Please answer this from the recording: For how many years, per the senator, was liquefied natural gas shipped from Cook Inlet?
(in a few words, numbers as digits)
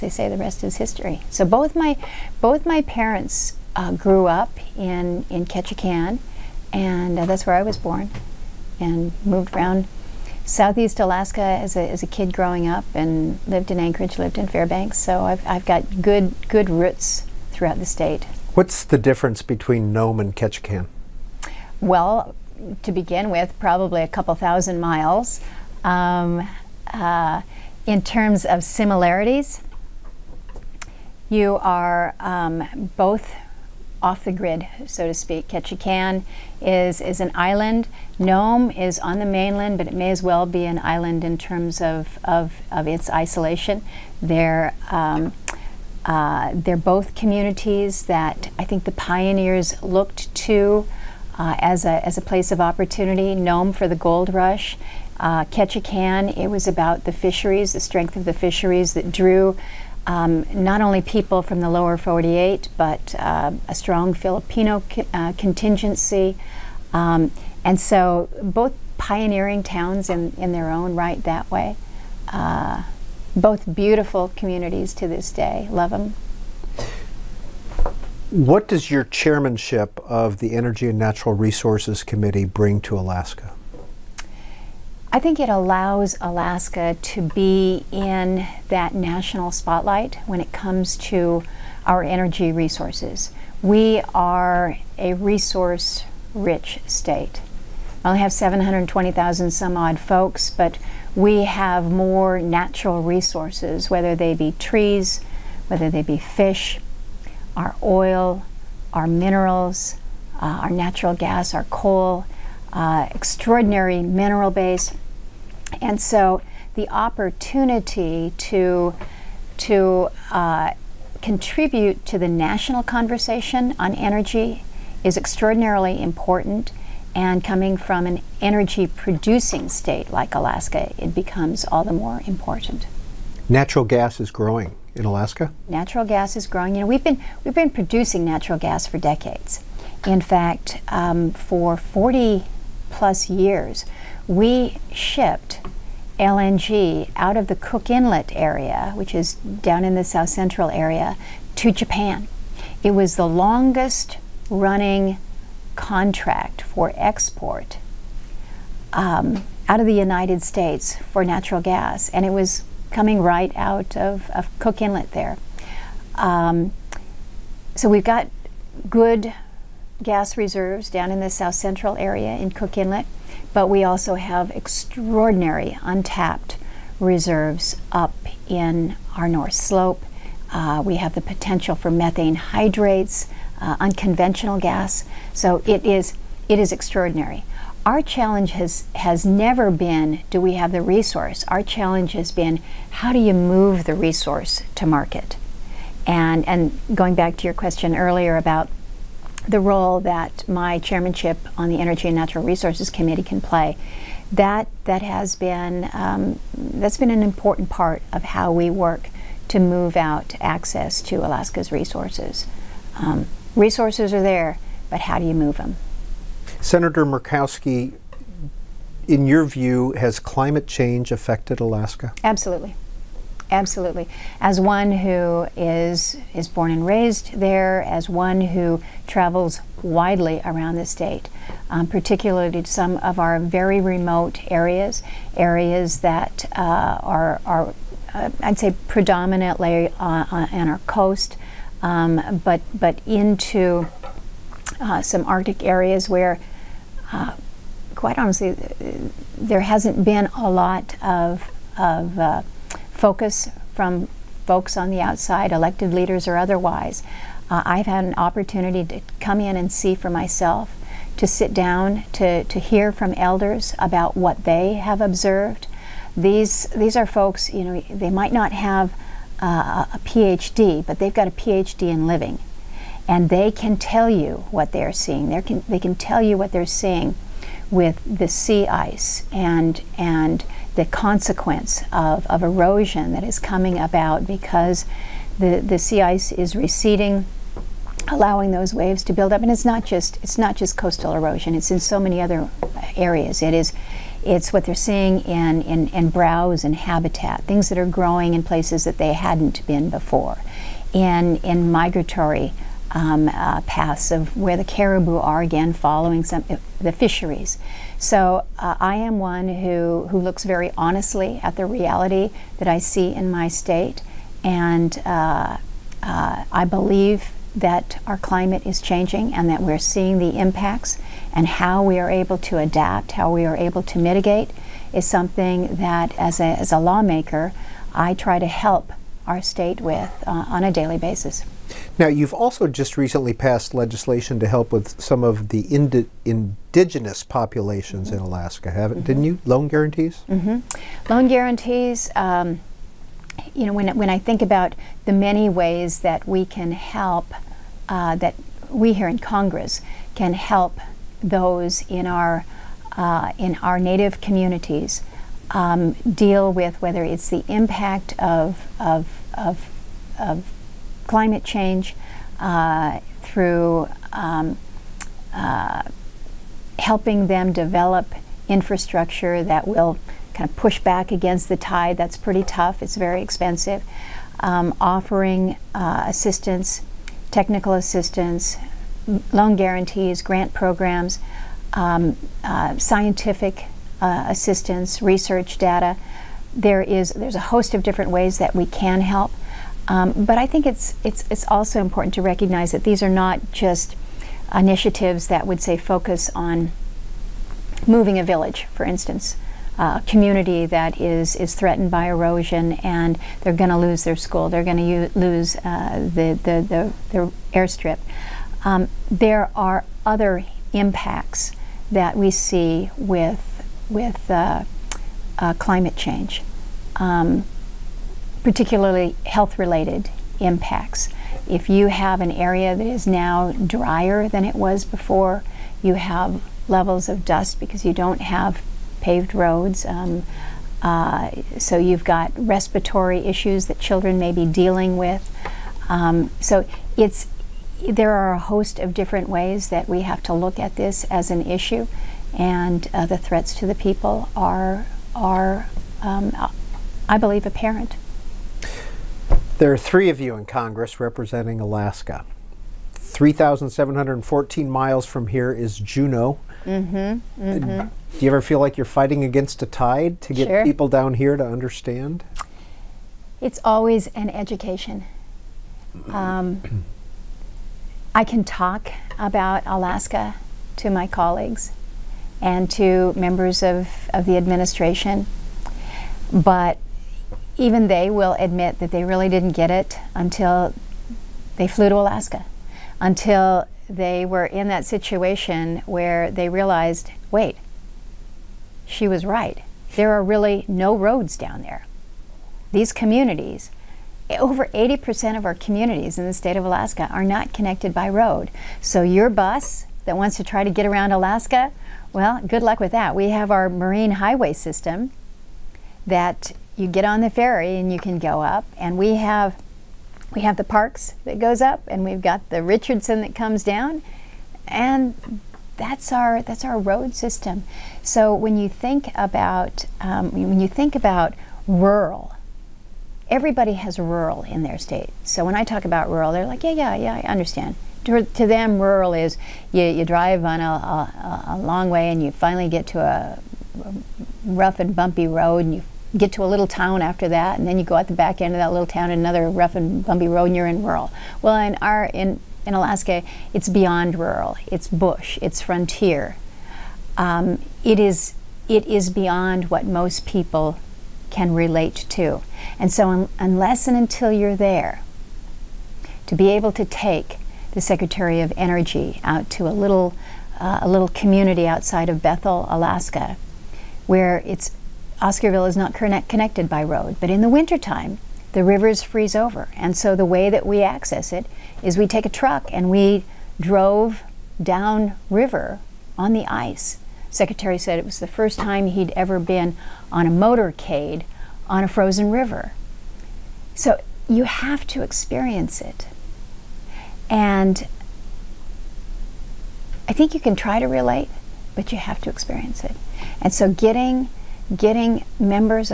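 40 plus years.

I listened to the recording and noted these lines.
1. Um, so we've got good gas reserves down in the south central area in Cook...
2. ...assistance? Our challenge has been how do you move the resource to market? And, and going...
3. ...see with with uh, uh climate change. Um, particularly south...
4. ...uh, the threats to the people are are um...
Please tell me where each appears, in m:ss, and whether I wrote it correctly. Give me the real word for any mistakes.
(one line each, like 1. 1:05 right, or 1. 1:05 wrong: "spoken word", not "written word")
1. 2:46 right
2. 3:10 wrong: "resource", not "assistance"
3. 6:52 wrong: "health", not "south"
4. 7:22 right.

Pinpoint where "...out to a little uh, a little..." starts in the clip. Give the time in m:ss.
9:19.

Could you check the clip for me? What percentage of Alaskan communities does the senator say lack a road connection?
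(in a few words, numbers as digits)
Over 80%.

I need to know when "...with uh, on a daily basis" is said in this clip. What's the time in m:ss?
5:29.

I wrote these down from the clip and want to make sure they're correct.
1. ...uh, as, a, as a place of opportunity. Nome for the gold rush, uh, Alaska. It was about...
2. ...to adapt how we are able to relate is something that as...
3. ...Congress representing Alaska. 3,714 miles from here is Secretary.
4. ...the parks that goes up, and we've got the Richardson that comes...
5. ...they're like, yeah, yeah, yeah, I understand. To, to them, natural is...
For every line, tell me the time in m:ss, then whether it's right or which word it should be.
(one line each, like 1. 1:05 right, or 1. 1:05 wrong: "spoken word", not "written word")
1. 0:51 wrong: "Ketchikan", not "Alaska"
2. 5:22 wrong: "mitigate", not "relate"
3. 7:30 wrong: "Juneau", not "Secretary"
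4. 8:30 right
5. 8:46 wrong: "rural", not "natural".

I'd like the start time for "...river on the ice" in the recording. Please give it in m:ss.
9:35.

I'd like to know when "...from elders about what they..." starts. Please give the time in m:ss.
4:22.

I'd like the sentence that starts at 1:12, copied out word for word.
Uh, both beautiful communities to this day.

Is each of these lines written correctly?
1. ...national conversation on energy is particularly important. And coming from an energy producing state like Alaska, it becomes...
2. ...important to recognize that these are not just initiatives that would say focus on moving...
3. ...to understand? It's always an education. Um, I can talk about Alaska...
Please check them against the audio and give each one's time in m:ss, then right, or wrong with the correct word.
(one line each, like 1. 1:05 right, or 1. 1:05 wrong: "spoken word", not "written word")
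1. 2:02 wrong: "extraordinarily", not "particularly"
2. 6:31 right
3. 7:41 right.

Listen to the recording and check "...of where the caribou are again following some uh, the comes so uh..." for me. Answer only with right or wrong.
wrong.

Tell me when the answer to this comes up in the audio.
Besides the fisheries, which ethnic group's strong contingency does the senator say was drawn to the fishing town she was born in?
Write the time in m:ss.
1:04.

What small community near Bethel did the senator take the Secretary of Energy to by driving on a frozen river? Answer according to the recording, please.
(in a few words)
Oscarville.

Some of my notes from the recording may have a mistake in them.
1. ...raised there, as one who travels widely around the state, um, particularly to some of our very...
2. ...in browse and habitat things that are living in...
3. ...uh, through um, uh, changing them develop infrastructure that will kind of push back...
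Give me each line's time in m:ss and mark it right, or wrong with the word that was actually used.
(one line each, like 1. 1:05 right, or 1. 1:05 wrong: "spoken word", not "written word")
1. 3:46 right
2. 4:55 wrong: "growing", not "living"
3. 6:02 wrong: "helping", not "changing".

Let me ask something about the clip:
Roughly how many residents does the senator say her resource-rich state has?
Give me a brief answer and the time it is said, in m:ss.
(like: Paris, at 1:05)
720,000, at 1:38.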